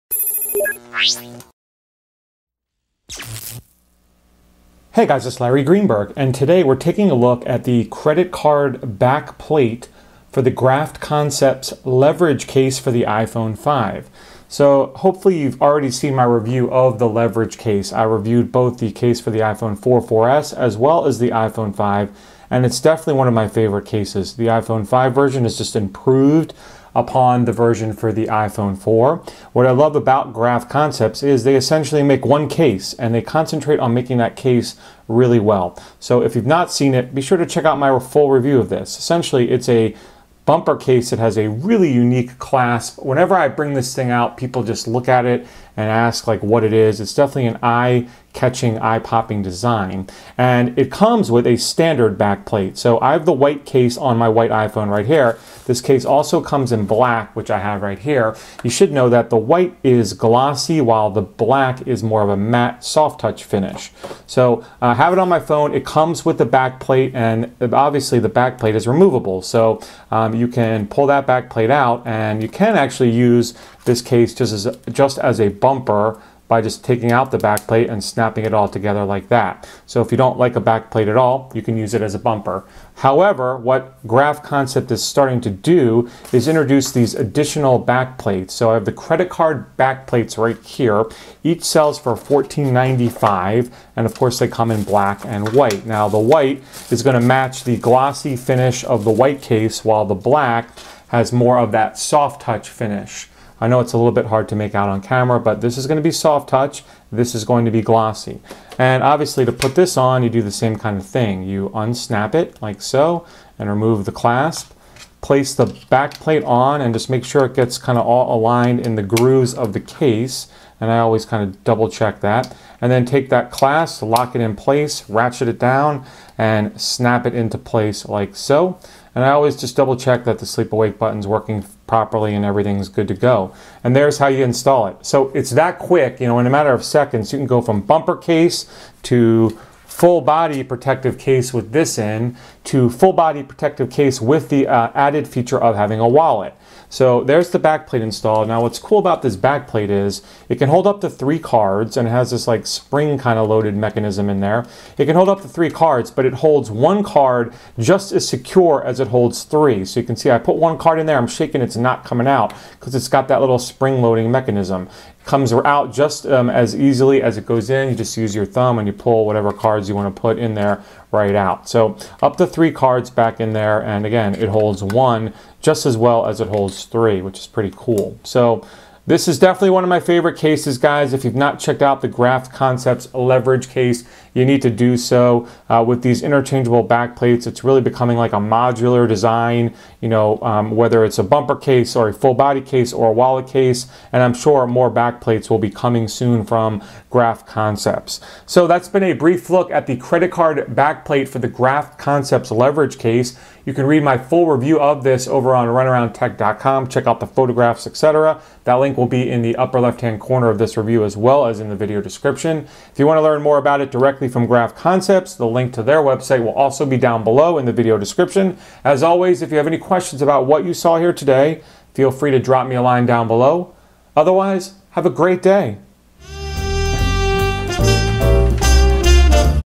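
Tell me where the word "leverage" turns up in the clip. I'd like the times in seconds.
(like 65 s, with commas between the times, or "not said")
11 s, 17 s, 183 s, 202 s.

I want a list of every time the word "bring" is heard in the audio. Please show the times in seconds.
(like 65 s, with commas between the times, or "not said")
43 s.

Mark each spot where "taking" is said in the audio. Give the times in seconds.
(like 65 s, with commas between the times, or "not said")
6 s, 76 s.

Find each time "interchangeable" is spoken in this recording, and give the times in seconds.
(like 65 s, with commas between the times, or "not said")
186 s.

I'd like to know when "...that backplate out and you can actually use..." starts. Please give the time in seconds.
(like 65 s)
71 s.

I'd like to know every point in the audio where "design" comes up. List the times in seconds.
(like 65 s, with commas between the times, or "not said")
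49 s, 189 s.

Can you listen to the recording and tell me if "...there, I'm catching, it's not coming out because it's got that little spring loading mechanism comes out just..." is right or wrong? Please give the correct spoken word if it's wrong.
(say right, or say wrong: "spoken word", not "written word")
wrong: "shaking", not "catching".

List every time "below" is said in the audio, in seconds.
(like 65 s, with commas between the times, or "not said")
217 s, 223 s.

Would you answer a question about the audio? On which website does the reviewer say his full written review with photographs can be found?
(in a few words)
runaroundtech.com.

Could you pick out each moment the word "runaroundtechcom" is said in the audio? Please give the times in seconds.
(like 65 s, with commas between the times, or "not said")
205 s.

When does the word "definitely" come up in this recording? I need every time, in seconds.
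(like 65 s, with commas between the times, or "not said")
22 s, 47 s, 179 s.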